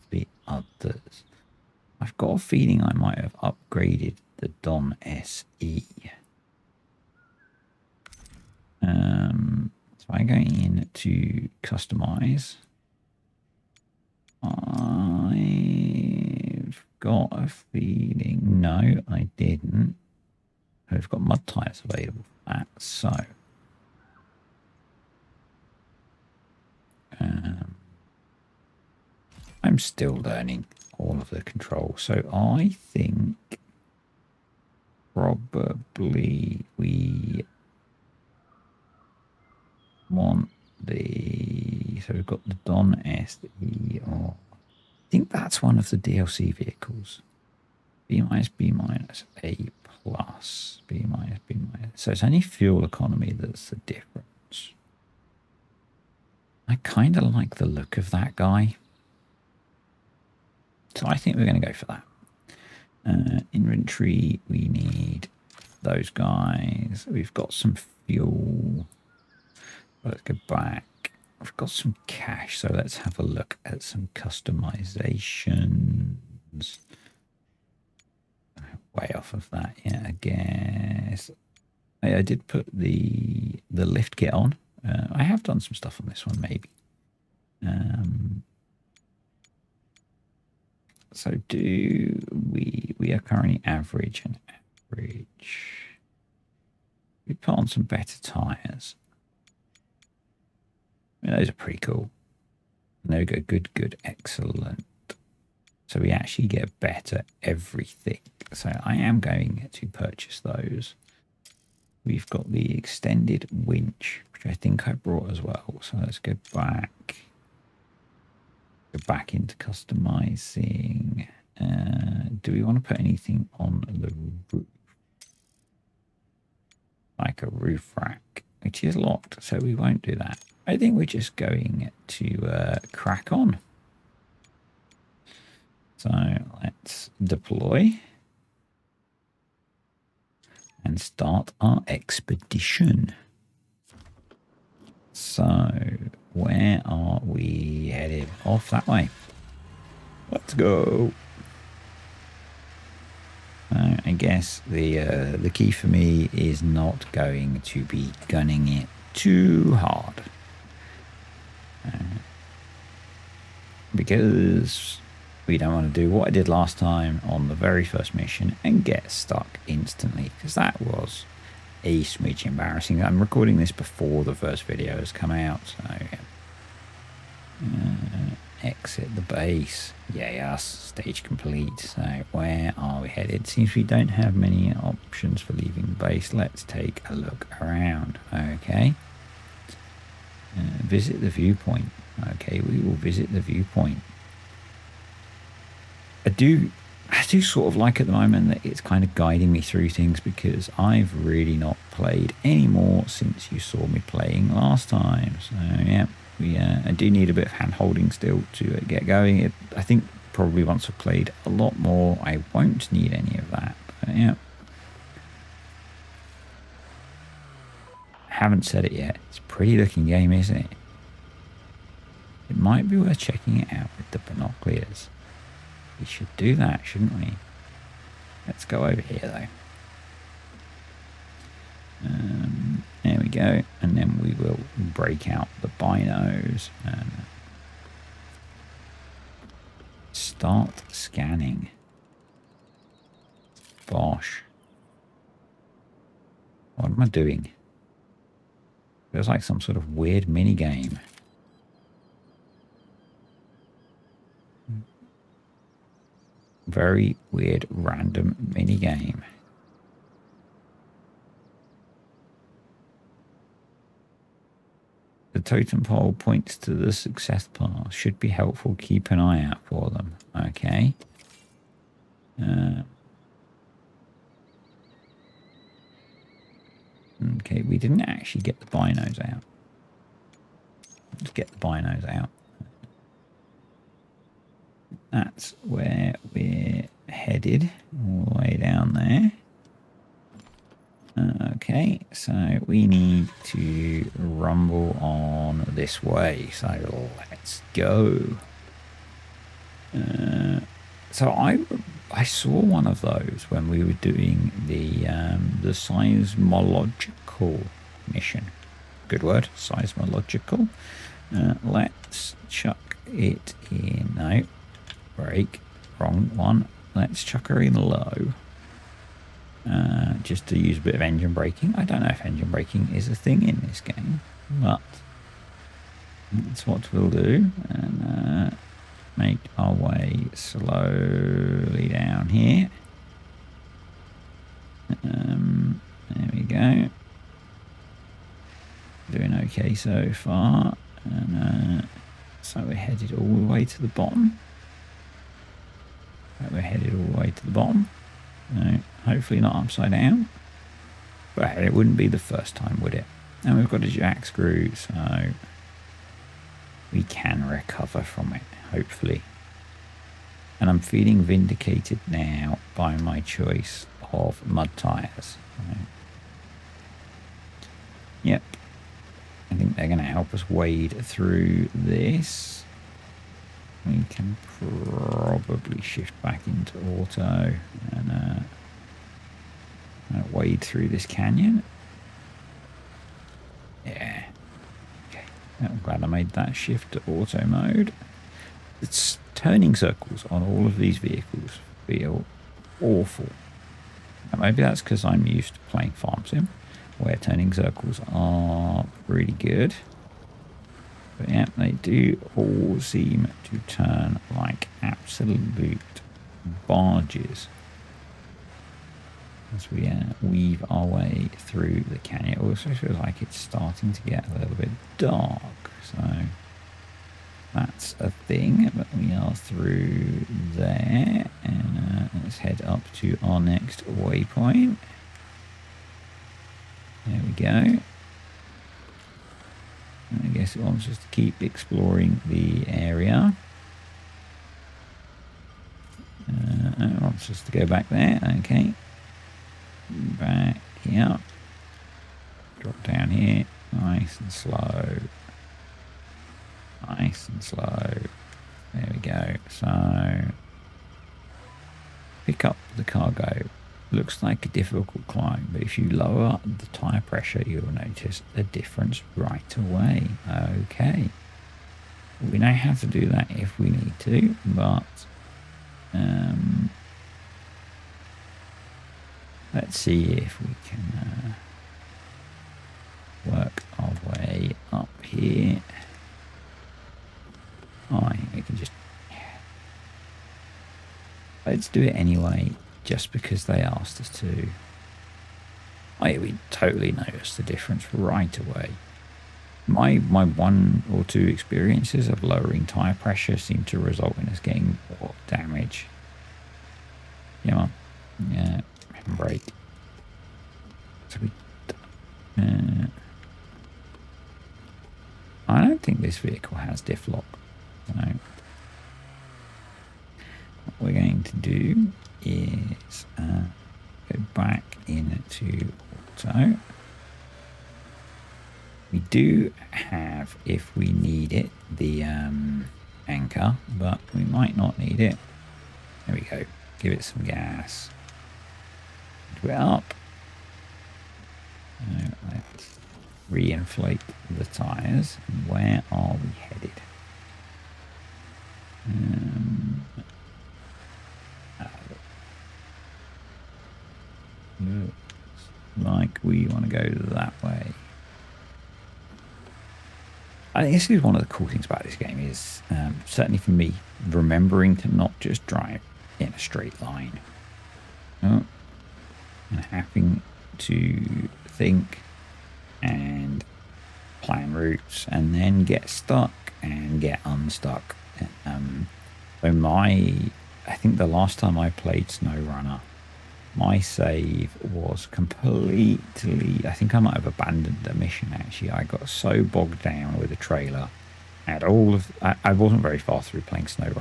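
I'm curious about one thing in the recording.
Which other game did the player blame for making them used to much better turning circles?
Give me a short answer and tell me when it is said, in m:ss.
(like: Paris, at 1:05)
Farm Sim, at 6:35.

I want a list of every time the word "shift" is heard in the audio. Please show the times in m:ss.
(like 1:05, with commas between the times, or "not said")
6:15, 6:26.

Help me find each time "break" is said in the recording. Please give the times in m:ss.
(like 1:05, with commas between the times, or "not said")
3:54, 5:15.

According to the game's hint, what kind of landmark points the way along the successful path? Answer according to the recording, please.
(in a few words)
Totem pole.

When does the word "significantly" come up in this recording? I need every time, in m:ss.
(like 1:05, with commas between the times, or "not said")
not said.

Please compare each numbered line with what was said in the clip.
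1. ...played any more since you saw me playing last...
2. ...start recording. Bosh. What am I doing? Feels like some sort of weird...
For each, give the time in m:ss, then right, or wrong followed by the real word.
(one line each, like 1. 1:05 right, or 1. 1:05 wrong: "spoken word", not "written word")
1. 3:21 right
2. 4:00 wrong: "scanning", not "recording".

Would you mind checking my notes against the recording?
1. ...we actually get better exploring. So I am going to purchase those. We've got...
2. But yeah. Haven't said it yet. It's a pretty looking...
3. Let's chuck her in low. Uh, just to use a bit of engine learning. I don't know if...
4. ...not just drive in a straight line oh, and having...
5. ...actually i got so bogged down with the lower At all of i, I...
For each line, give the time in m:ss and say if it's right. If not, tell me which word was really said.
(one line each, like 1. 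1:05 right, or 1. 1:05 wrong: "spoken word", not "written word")
1. 1:46 wrong: "everything", not "exploring"
2. 3:34 right
3. 5:16 wrong: "braking", not "learning"
4. 9:14 right
5. 9:38 wrong: "trailer", not "lower".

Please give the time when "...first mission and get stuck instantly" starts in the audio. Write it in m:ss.
2:47.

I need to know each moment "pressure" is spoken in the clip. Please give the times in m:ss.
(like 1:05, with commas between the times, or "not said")
7:37, 8:12.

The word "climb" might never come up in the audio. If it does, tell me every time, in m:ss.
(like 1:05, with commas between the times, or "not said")
7:35.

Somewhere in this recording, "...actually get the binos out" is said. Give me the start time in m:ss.
4:38.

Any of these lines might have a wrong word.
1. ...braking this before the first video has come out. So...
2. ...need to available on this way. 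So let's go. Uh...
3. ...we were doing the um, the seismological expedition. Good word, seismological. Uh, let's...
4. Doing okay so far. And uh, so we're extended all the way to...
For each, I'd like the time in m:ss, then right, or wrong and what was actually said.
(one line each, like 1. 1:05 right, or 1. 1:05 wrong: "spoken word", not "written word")
1. 2:53 wrong: "recording", not "braking"
2. 4:52 wrong: "rumble", not "available"
3. 5:03 wrong: "mission", not "expedition"
4. 5:39 wrong: "headed", not "extended".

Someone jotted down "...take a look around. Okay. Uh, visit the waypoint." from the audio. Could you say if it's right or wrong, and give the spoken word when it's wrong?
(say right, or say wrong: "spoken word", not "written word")
wrong: "viewpoint", not "waypoint".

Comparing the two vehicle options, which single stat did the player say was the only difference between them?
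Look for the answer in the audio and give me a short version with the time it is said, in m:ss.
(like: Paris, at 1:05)
Fuel economy, at 0:52.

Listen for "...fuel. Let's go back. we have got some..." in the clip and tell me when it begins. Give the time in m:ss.
1:08.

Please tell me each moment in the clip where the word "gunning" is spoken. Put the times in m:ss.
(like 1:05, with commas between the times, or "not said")
2:38.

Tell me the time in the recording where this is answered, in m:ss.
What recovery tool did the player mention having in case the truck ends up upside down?
5:53.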